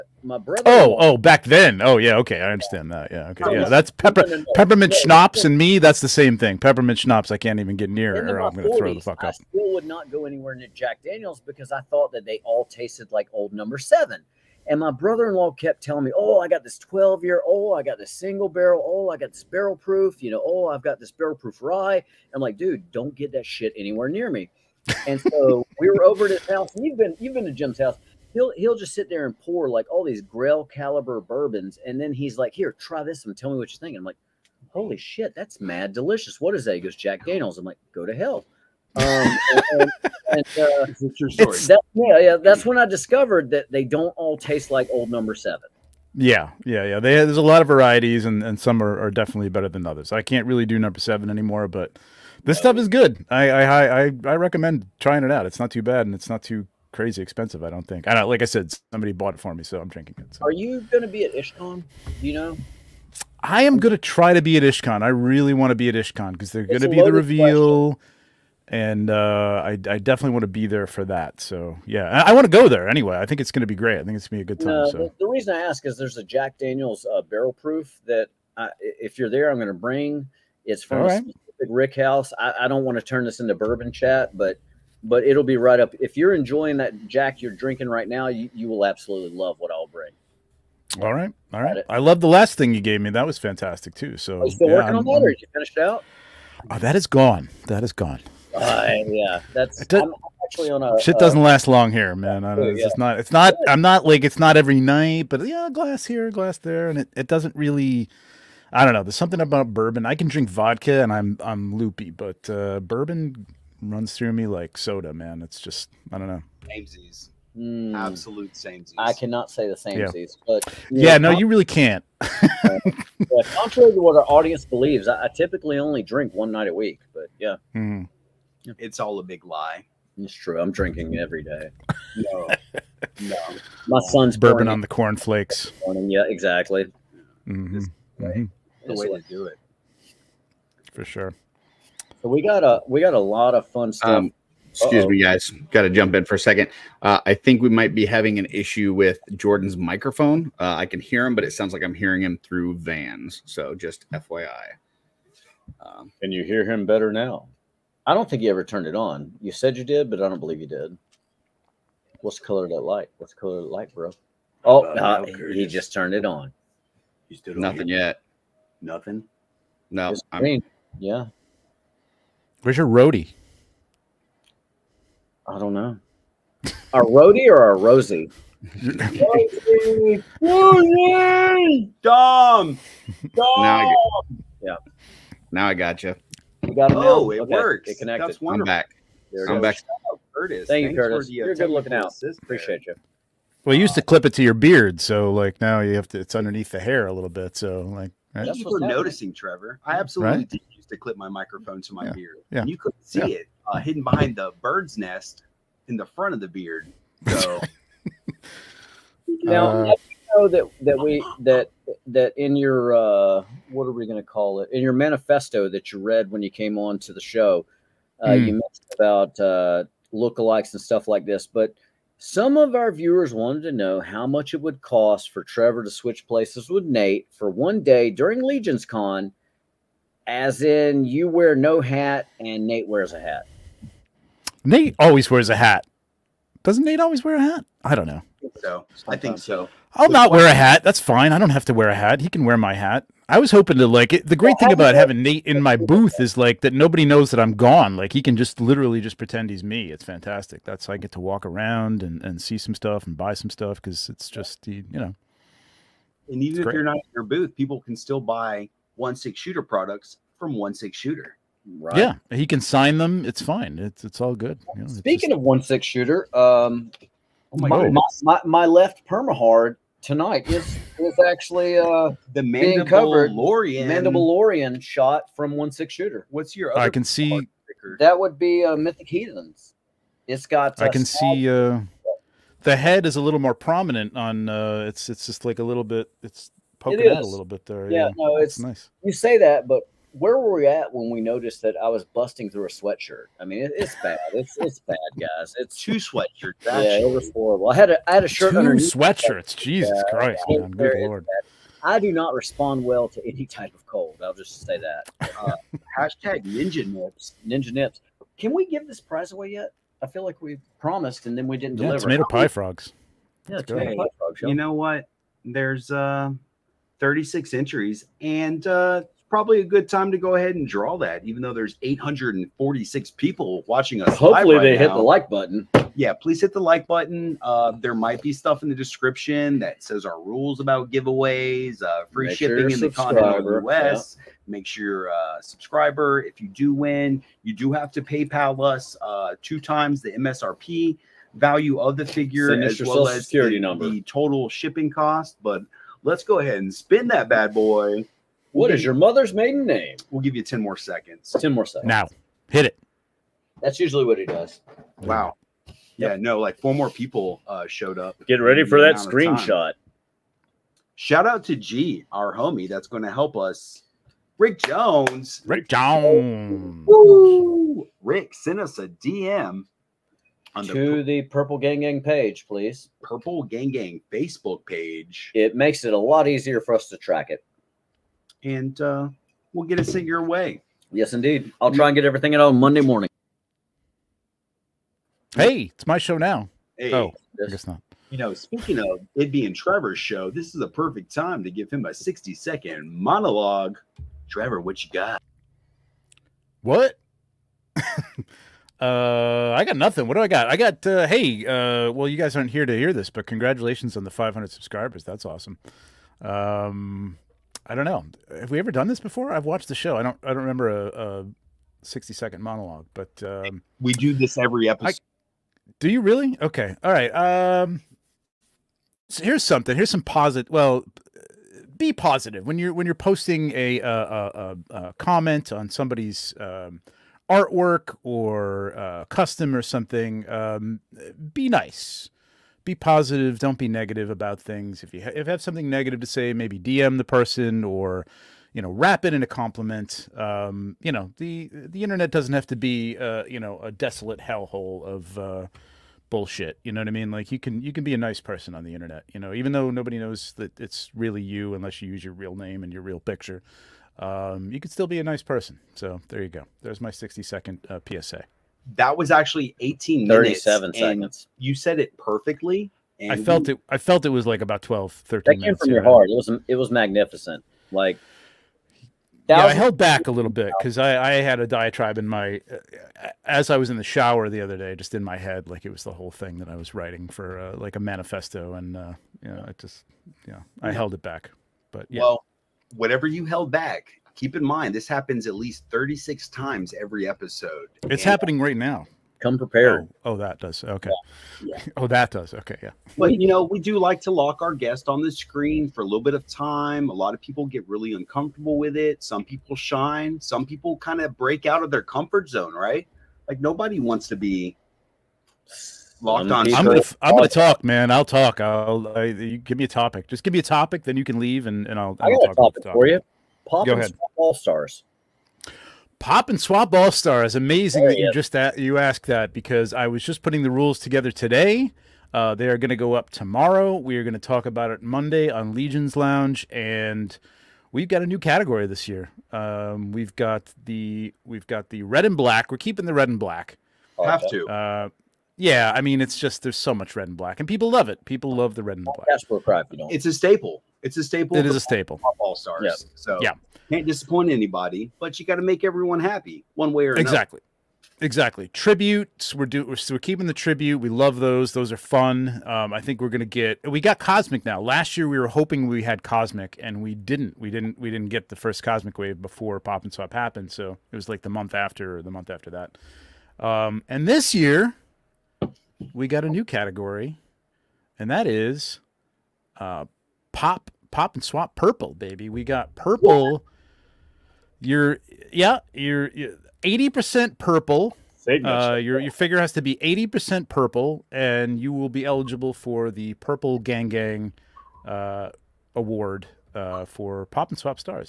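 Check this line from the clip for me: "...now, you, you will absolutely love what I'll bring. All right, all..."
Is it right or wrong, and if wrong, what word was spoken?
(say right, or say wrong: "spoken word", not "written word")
right.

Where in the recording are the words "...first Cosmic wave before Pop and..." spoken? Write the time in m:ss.
9:18.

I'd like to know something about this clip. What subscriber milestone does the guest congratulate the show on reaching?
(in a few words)
500.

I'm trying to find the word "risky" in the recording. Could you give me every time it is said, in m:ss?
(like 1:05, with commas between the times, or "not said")
not said.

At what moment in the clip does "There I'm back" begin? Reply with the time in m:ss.
3:09.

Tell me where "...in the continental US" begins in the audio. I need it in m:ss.
5:32.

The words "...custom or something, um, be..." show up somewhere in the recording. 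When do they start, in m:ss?
7:09.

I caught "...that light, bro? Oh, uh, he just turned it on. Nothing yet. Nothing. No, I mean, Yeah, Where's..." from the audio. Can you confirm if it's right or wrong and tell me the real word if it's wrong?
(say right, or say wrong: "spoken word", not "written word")
right.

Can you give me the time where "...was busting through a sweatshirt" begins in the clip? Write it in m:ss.
4:51.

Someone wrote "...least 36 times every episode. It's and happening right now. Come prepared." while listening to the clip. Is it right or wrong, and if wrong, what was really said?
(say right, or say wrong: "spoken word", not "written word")
right.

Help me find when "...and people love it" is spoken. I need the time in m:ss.
8:57.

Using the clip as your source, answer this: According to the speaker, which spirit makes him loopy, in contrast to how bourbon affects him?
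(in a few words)
vodka.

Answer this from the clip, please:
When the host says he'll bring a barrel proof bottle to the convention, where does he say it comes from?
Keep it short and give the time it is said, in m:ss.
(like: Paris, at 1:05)
Rick House, at 1:21.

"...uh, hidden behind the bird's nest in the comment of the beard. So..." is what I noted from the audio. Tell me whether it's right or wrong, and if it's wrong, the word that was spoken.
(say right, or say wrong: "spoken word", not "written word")
wrong: "front", not "comment".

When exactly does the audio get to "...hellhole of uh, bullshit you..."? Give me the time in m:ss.
7:24.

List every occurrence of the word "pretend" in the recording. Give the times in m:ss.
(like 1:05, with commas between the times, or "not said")
4:09.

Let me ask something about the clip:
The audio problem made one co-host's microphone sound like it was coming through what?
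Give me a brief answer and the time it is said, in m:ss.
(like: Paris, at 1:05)
Vans, at 2:32.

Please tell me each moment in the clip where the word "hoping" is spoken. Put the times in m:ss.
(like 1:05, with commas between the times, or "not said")
4:03, 9:15.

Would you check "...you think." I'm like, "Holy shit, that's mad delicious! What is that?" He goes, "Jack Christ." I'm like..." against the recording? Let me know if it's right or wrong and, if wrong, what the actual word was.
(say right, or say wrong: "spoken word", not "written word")
wrong: "Daniels", not "Christ".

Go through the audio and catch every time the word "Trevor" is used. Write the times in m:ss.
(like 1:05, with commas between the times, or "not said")
3:19, 3:45, 6:29, 6:34.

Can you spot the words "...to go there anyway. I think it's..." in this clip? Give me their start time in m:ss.
1:12.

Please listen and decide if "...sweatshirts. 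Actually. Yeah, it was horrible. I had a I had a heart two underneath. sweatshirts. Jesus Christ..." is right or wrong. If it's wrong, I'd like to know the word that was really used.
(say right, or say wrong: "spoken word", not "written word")
wrong: "shirt", not "heart".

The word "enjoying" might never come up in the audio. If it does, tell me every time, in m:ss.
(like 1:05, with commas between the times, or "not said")
1:26.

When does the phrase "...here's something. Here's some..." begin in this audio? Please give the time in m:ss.
6:59.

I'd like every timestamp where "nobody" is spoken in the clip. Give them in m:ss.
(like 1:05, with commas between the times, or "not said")
4:06, 7:29, 8:23.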